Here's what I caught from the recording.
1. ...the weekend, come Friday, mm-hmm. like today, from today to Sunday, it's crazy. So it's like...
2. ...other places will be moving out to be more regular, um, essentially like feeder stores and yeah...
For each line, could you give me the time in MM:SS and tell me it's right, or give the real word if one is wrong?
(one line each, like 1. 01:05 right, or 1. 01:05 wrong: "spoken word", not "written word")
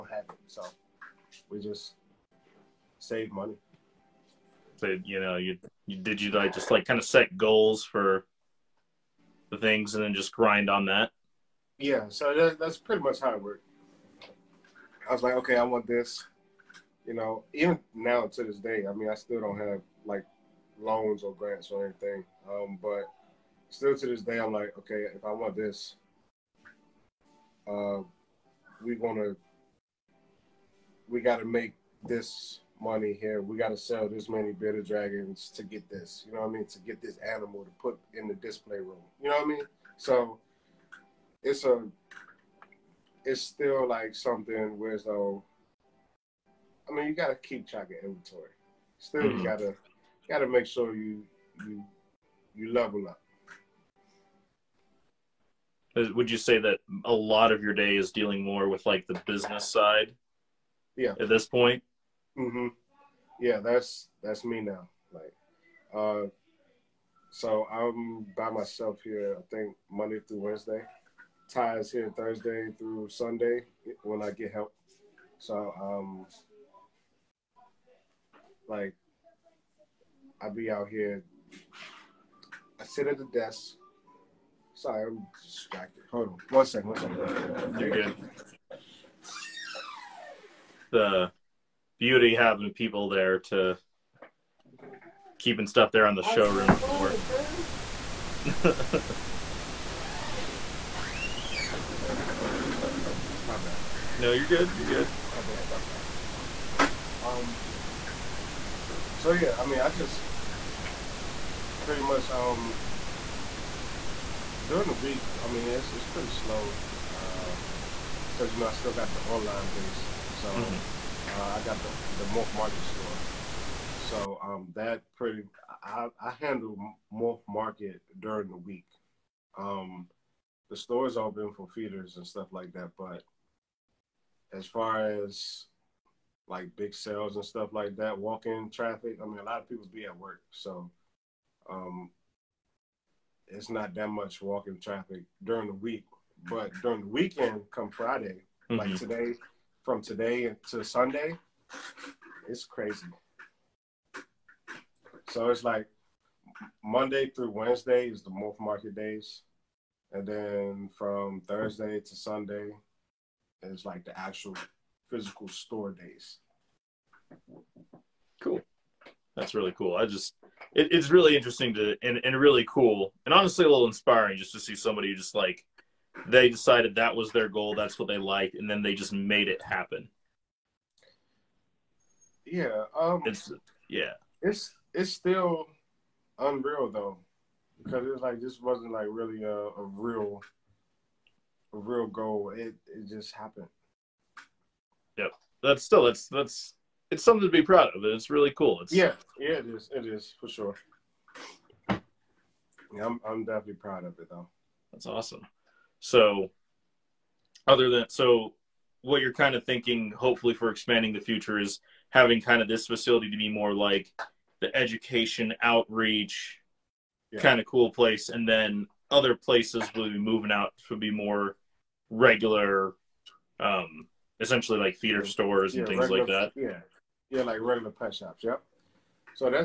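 1. 02:27 right
2. 03:39 right.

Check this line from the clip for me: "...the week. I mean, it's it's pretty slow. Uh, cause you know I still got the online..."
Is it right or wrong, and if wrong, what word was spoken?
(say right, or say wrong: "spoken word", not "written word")
right.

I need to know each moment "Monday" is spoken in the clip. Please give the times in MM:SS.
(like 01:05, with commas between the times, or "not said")
01:09, 02:36.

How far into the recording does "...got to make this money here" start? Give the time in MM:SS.
00:31.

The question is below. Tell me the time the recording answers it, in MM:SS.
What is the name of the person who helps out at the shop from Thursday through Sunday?
01:11.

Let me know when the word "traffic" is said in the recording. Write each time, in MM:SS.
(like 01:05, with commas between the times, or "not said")
02:18, 02:24.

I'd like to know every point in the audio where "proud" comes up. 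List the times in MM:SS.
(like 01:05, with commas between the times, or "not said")
03:17, 03:23.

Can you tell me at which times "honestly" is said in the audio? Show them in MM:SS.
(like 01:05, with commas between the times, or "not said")
02:53.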